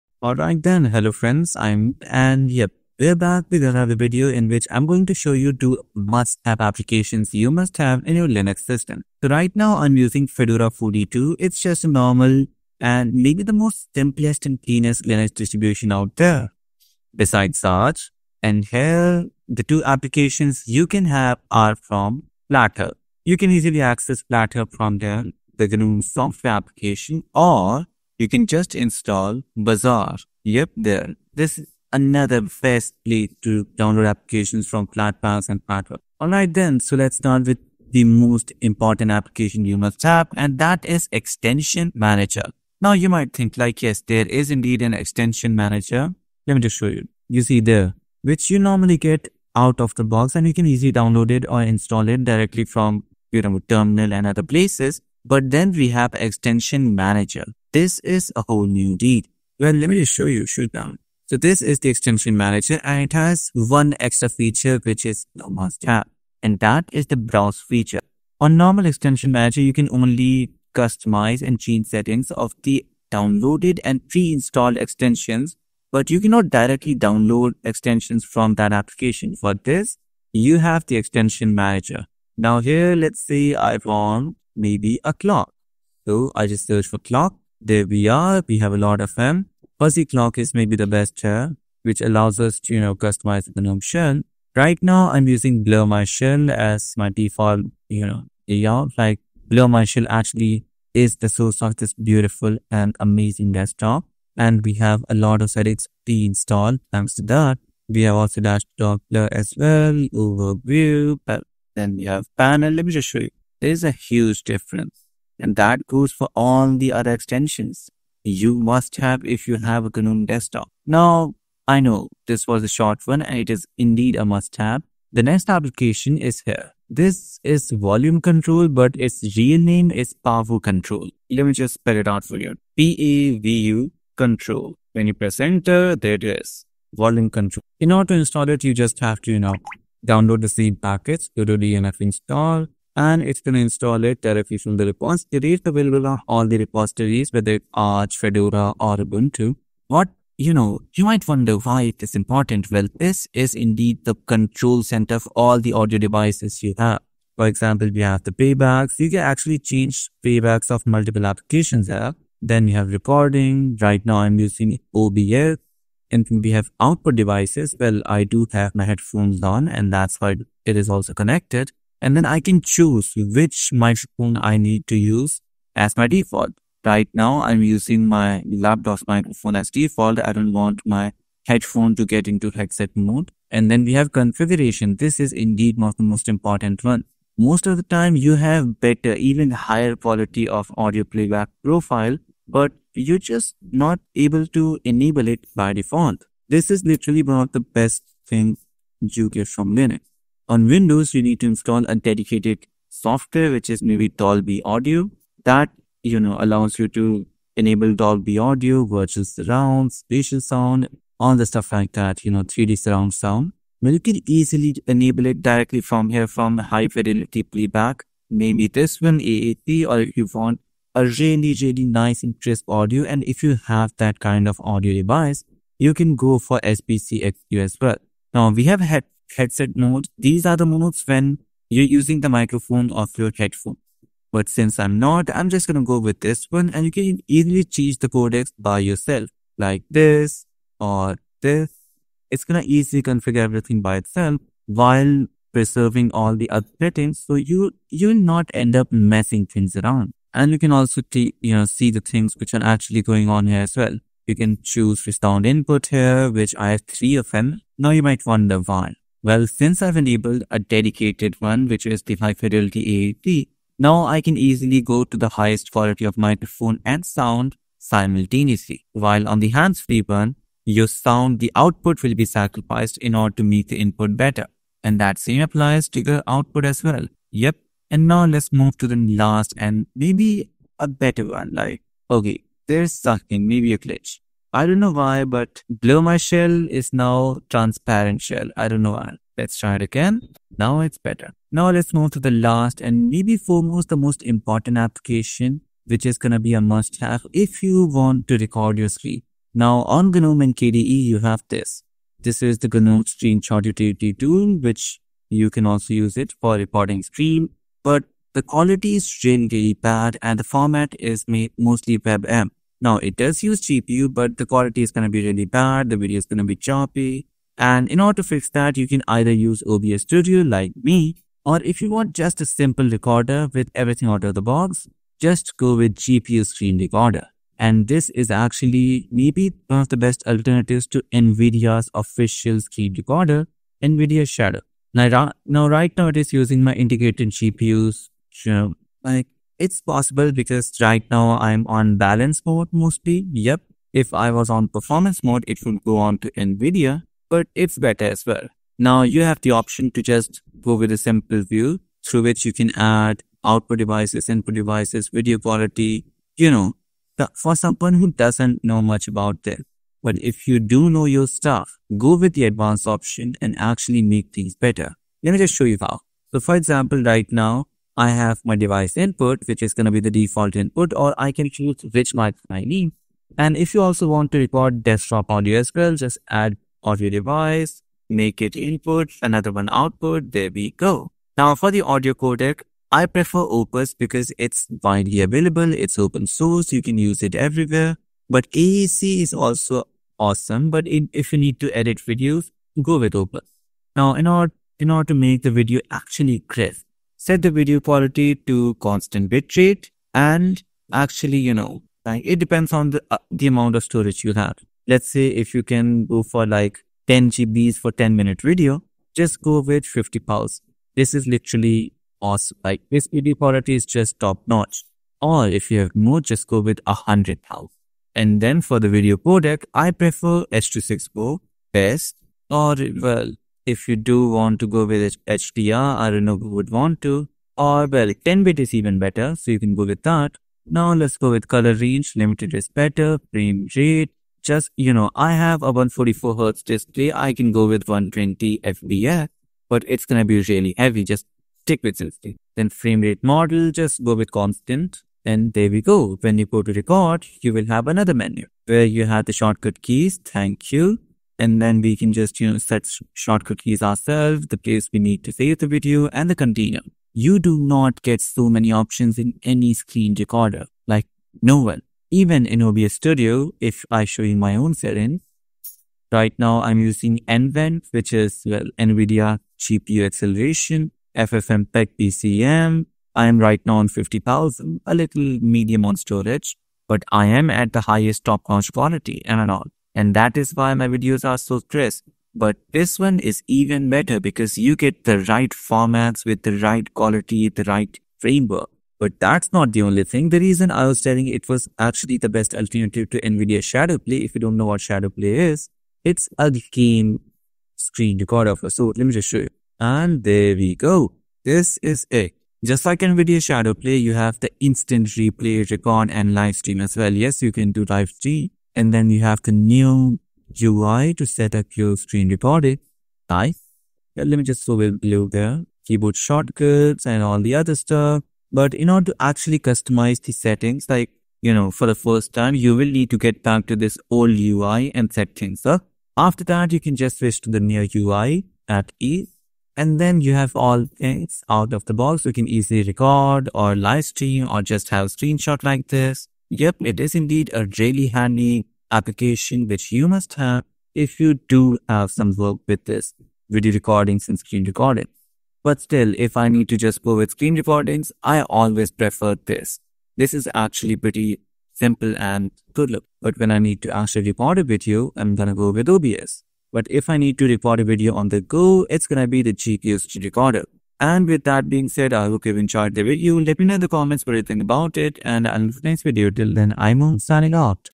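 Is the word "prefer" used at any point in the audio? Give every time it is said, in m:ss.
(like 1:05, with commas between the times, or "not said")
6:23, 6:59, 9:08.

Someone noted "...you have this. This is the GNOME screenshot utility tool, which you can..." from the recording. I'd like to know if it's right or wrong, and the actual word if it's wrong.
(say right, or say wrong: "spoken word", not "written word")
right.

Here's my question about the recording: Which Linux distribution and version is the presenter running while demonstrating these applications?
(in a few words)
Fedora 42.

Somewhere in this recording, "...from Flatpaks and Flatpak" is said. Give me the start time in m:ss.
0:34.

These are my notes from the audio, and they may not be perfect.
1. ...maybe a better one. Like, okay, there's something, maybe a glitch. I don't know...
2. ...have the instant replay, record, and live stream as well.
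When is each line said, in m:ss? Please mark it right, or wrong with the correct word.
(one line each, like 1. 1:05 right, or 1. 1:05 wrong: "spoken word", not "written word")
1. 4:39 right
2. 8:24 right.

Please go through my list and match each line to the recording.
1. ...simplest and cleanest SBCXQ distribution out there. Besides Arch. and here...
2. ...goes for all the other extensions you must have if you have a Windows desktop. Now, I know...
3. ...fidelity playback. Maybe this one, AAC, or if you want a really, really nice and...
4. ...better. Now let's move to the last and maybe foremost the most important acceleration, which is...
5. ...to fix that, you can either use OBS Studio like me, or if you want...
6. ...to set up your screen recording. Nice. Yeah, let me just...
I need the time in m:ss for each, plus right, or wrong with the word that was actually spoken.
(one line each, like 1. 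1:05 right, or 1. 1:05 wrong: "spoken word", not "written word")
1. 0:13 wrong: "Linux", not "SBCXQ"
2. 1:55 wrong: "GNOME", not "Windows"
3. 3:36 right
4. 4:50 wrong: "application", not "acceleration"
5. 5:18 right
6. 8:31 right.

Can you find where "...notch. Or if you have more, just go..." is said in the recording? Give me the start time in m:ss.
6:54.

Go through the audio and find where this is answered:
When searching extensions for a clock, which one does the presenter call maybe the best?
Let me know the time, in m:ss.
1:29.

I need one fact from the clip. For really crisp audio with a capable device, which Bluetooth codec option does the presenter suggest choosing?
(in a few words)
SBC-XQ.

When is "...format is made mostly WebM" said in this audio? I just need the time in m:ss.
5:10.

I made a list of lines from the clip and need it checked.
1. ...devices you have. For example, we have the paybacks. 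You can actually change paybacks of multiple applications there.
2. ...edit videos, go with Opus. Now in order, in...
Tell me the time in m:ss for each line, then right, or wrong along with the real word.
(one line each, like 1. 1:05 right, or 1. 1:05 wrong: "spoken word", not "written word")
1. 2:35 right
2. 6:31 right.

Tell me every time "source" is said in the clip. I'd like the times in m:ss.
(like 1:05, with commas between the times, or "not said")
1:41, 6:26.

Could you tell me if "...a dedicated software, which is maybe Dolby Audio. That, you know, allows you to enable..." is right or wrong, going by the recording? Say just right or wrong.
right.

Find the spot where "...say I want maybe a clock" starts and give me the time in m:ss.
1:23.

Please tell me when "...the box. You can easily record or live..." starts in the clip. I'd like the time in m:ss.
8:51.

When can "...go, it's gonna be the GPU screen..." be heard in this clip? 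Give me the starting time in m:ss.
9:18.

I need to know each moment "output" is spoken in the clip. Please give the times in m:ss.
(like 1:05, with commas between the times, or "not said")
2:46, 4:31, 4:36, 5:53, 6:19.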